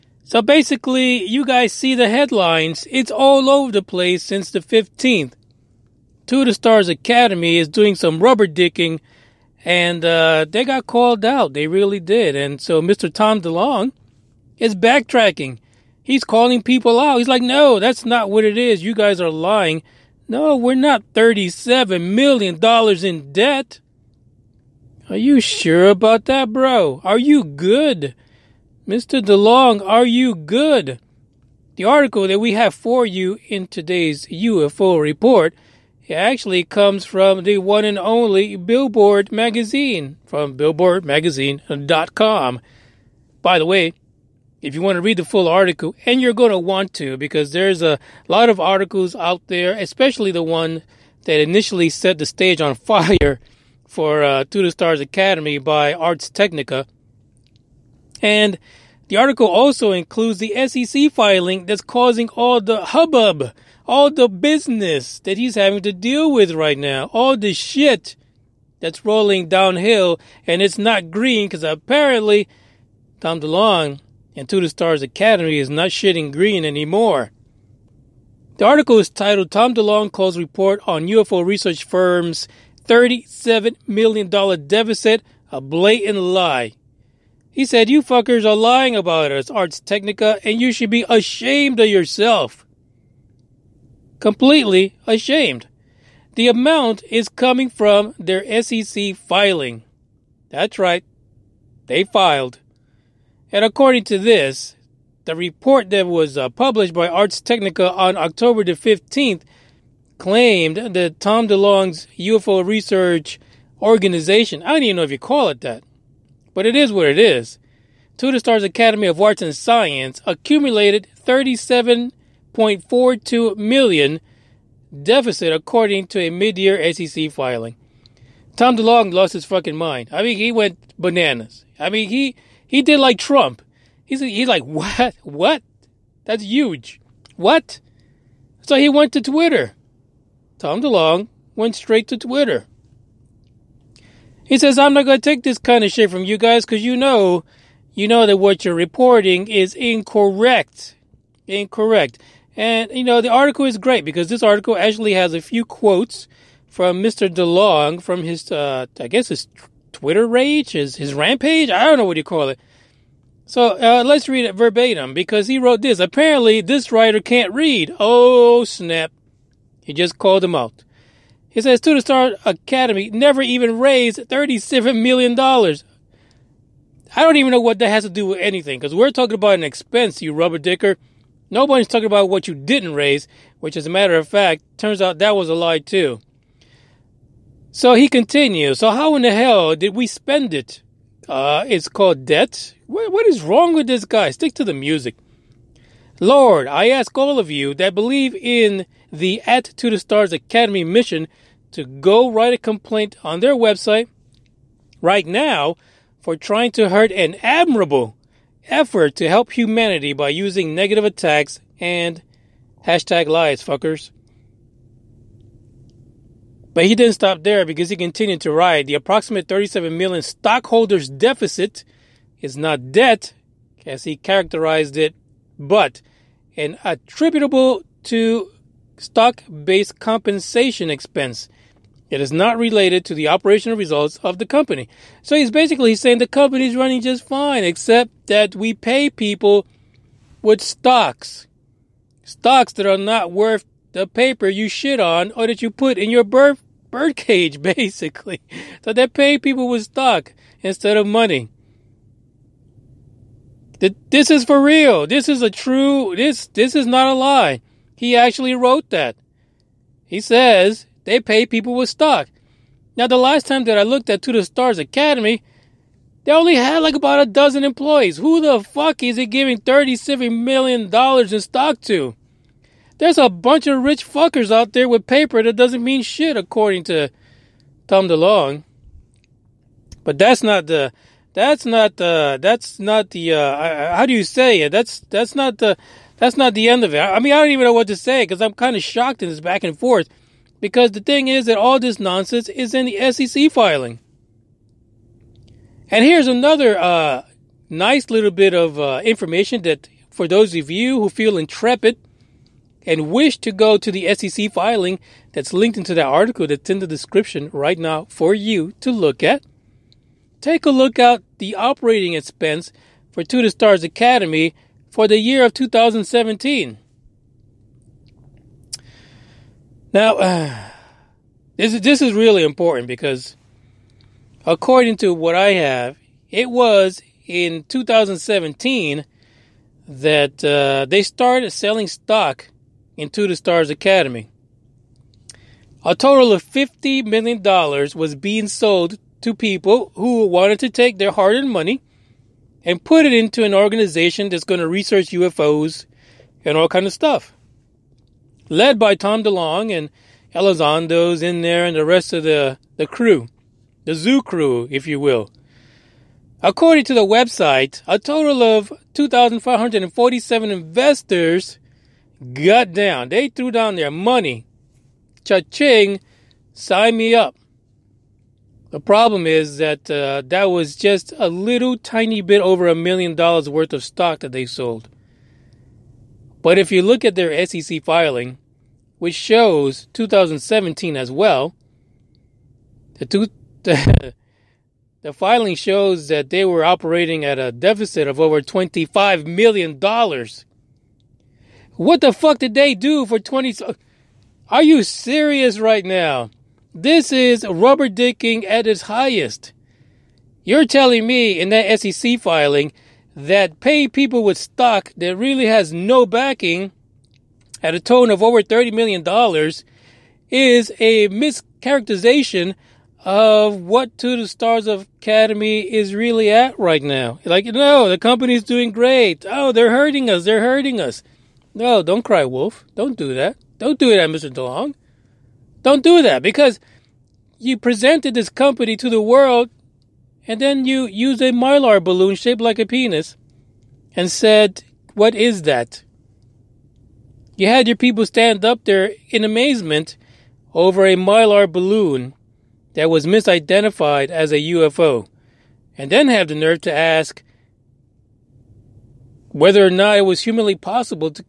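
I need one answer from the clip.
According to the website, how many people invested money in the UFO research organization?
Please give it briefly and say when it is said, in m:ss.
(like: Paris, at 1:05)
2,547, at 5:58.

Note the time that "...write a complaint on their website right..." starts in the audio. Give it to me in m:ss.
3:22.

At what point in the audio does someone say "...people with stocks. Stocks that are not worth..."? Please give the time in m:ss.
3:59.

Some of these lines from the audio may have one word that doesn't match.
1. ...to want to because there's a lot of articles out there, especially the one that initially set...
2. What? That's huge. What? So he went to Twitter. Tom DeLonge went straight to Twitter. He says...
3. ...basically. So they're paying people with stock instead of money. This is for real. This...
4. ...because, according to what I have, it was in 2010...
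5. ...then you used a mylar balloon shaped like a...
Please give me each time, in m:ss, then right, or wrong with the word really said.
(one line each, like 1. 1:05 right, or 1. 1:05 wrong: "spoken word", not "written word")
1. 0:46 right
2. 2:15 right
3. 4:07 right
4. 5:22 wrong: "2017", not "2010"
5. 7:10 right.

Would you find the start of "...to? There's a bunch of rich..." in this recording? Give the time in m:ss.
4:31.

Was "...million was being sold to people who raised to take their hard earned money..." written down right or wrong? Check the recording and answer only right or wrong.
wrong.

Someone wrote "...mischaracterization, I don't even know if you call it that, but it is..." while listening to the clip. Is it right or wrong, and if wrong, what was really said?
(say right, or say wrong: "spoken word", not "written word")
wrong: "organization", not "mischaracterization".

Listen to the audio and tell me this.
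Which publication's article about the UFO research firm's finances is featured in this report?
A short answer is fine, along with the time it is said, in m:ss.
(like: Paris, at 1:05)
Billboard, at 0:38.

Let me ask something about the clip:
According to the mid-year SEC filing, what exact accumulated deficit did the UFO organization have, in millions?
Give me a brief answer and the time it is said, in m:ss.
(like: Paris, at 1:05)
$37.42 million, at 2:01.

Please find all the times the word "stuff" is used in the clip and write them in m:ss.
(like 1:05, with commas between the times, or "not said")
5:46.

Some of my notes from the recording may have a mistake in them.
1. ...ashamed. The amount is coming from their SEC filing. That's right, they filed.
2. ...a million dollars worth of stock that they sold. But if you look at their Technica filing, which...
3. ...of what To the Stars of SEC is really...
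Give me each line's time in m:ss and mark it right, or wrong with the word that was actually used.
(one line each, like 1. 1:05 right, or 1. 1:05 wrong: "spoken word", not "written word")
1. 1:35 right
2. 6:12 wrong: "SEC", not "Technica"
3. 6:53 wrong: "Academy", not "SEC".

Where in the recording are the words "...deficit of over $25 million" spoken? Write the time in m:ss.
6:27.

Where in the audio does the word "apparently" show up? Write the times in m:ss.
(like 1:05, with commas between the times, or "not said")
1:11, 2:46.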